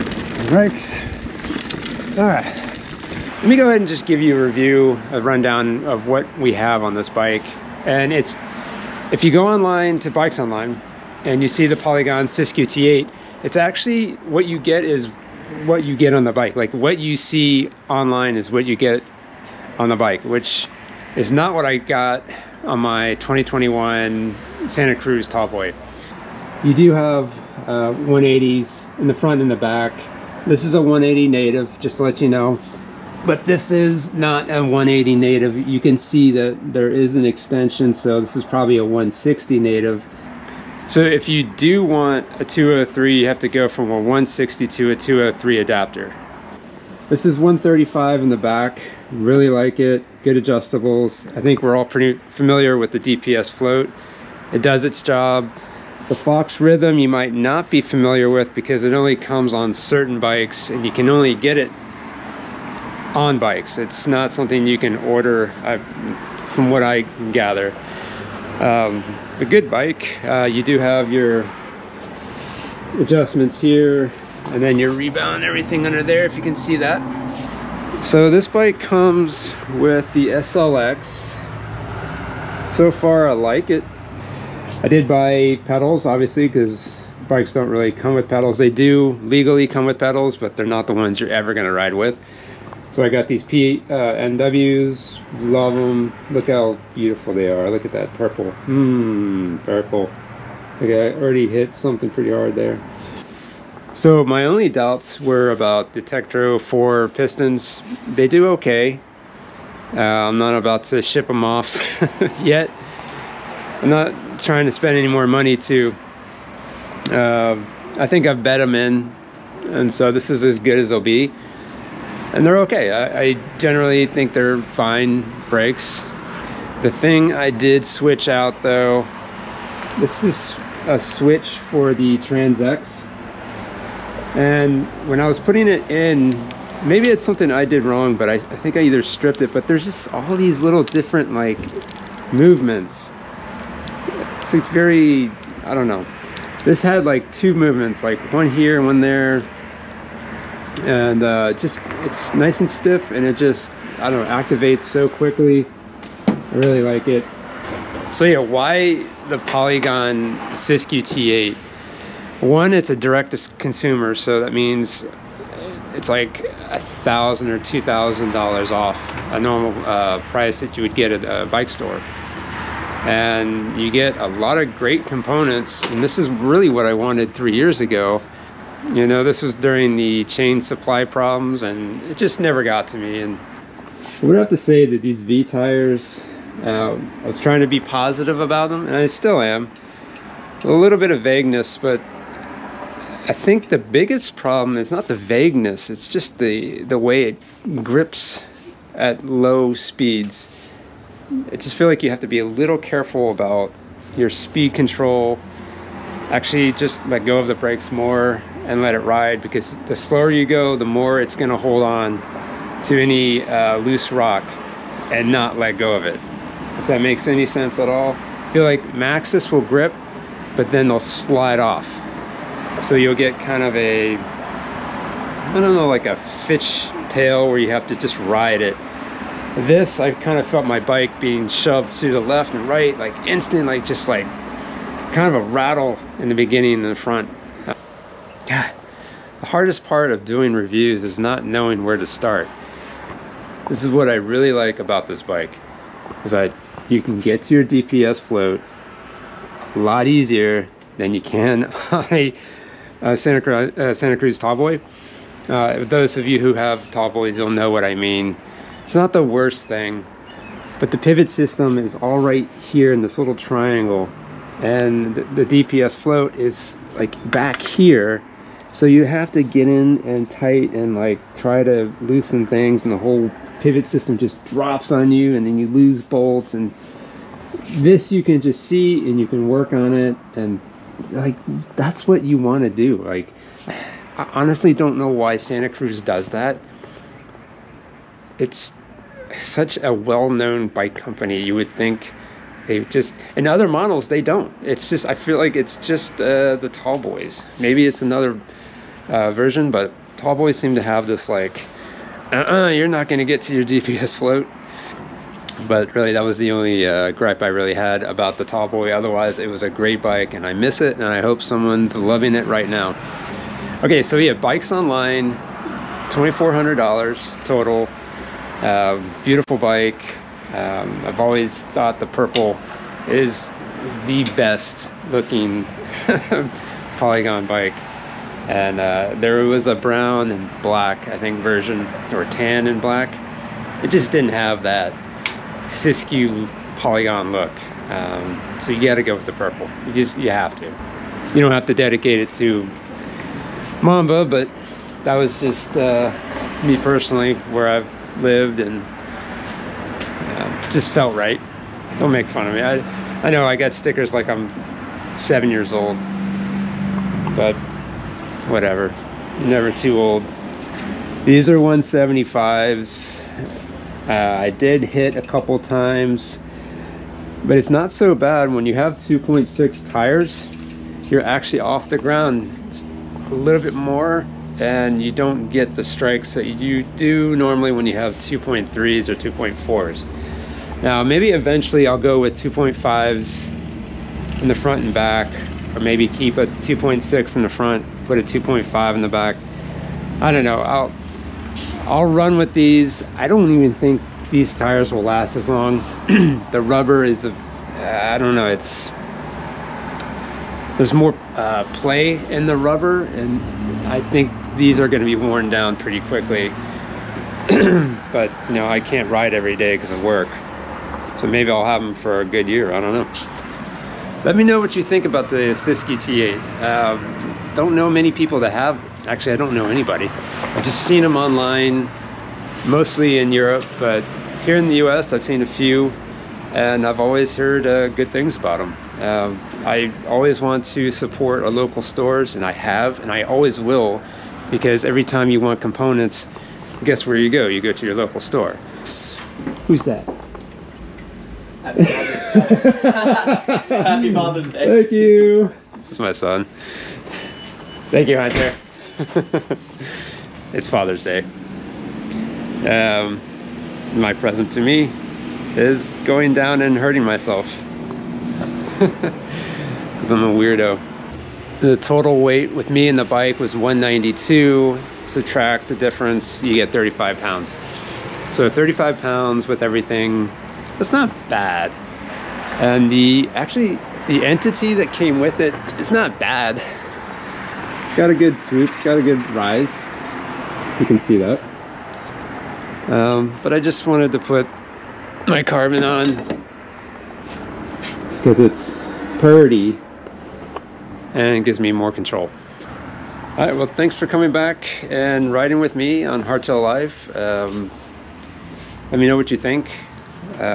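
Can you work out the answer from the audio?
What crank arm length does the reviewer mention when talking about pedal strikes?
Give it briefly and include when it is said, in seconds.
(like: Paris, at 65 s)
175, at 361 s.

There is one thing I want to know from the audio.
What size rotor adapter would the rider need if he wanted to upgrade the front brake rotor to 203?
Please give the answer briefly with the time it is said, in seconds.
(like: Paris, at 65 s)
160 to 203, at 43 s.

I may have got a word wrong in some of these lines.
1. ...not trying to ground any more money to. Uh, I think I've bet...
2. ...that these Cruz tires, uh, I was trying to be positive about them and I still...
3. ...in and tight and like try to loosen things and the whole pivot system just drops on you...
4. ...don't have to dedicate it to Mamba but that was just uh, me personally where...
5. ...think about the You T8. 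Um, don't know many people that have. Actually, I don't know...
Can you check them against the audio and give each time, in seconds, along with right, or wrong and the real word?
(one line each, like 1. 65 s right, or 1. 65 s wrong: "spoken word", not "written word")
1. 113 s wrong: "spend", not "ground"
2. 184 s wrong: "Vee", not "Cruz"
3. 269 s right
4. 341 s right
5. 414 s wrong: "Siski", not "You".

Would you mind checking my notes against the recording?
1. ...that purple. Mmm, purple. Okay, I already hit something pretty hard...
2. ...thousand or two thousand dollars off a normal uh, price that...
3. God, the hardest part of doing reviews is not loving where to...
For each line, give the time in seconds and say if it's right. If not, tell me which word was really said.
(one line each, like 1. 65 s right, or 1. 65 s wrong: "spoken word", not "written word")
1. 97 s right
2. 167 s right
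3. 238 s wrong: "knowing", not "loving".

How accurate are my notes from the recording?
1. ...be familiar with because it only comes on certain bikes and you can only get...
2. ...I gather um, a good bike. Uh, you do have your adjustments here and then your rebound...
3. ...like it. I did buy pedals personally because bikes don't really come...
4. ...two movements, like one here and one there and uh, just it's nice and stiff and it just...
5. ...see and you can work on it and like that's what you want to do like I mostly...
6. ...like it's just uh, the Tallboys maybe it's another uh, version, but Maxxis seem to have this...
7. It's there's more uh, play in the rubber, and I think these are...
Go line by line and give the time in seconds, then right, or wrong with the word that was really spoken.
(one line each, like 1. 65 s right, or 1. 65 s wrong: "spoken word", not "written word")
1. 57 s right
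2. 66 s right
3. 83 s wrong: "obviously", not "personally"
4. 147 s right
5. 278 s wrong: "honestly", not "mostly"
6. 295 s wrong: "Tallboys", not "Maxxis"
7. 398 s right.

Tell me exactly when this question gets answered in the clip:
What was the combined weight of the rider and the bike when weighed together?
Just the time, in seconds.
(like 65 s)
463 s.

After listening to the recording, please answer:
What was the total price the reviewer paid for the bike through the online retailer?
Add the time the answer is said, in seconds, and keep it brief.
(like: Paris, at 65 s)
$2,400, at 316 s.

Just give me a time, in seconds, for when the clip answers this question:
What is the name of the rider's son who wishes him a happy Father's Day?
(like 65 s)
448 s.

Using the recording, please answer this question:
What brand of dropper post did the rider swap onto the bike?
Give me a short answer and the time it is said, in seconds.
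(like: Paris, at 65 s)
TranzX, at 132 s.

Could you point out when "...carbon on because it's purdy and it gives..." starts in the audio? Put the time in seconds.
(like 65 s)
485 s.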